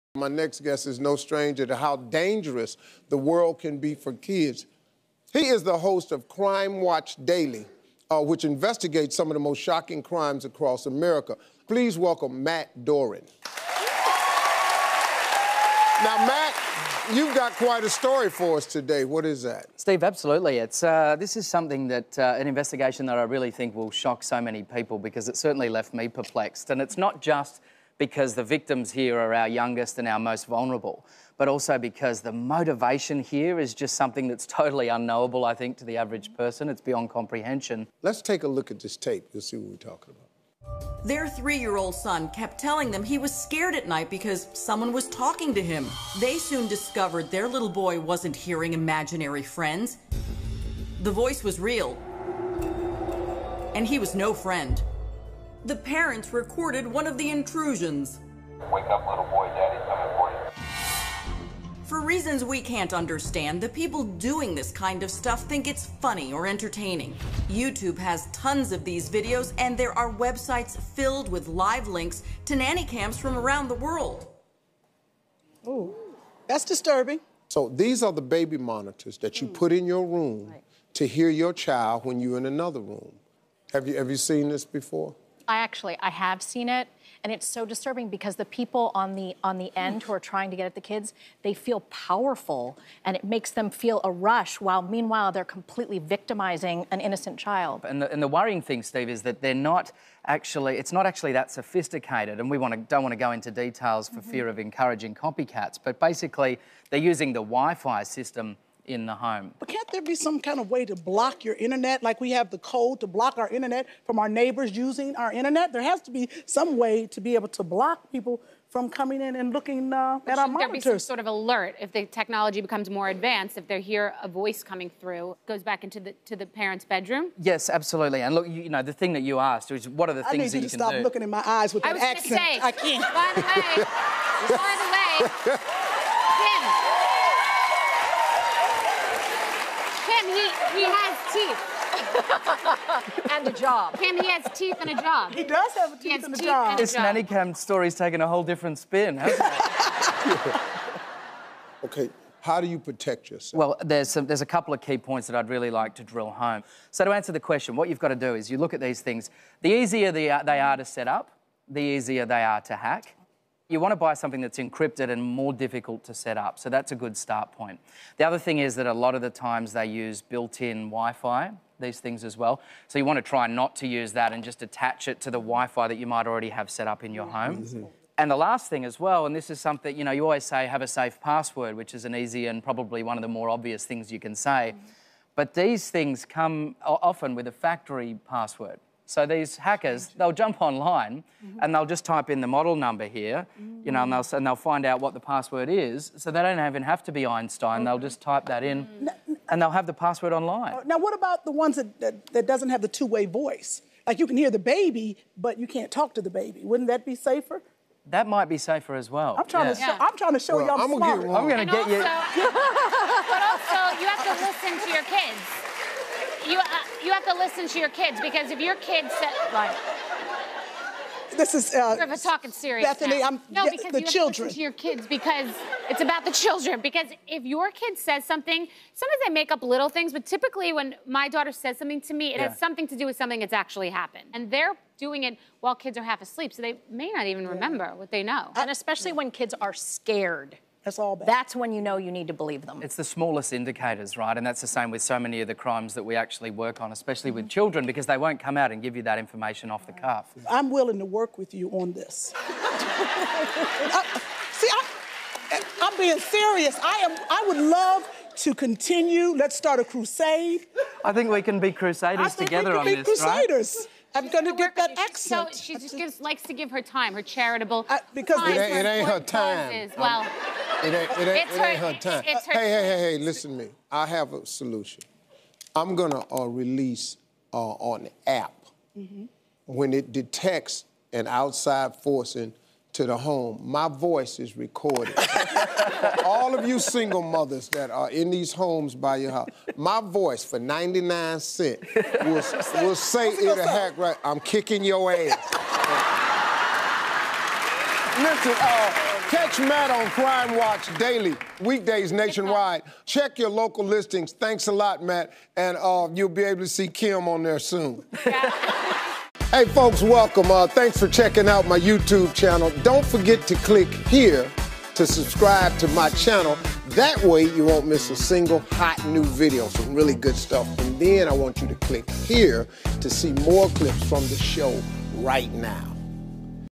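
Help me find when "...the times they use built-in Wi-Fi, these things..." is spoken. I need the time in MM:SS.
02:49.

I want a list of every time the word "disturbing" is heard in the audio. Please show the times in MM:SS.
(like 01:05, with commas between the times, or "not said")
01:16, 01:27.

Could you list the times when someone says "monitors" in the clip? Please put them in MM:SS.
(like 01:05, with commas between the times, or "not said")
01:18, 02:00.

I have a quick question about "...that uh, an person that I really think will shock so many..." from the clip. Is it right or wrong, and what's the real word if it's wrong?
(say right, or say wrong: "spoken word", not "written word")
wrong: "investigation", not "person".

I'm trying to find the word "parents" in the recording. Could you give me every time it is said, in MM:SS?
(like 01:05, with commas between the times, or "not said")
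00:55, 02:06.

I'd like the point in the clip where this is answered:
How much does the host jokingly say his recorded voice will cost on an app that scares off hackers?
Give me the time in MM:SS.
04:50.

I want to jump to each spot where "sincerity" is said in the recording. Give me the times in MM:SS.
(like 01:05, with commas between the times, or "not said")
not said.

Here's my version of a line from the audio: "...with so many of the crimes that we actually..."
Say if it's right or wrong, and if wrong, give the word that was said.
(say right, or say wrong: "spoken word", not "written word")
right.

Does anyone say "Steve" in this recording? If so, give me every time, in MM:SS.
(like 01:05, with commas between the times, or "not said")
00:19, 01:38.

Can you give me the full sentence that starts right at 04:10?
I'm willing to work with you on this.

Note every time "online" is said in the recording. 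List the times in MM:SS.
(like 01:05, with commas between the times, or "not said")
03:10, 03:20.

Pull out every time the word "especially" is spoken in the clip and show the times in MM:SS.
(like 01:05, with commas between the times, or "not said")
03:58, 04:06.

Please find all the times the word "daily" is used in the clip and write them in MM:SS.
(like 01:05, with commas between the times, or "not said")
00:07, 05:00.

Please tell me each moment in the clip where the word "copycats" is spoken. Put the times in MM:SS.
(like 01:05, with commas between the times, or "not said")
01:45.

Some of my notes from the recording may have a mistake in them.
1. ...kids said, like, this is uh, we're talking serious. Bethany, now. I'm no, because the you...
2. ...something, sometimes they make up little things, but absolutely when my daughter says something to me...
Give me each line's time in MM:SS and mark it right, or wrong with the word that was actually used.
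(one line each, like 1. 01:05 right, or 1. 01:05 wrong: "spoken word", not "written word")
1. 03:38 right
2. 03:48 wrong: "typically", not "absolutely".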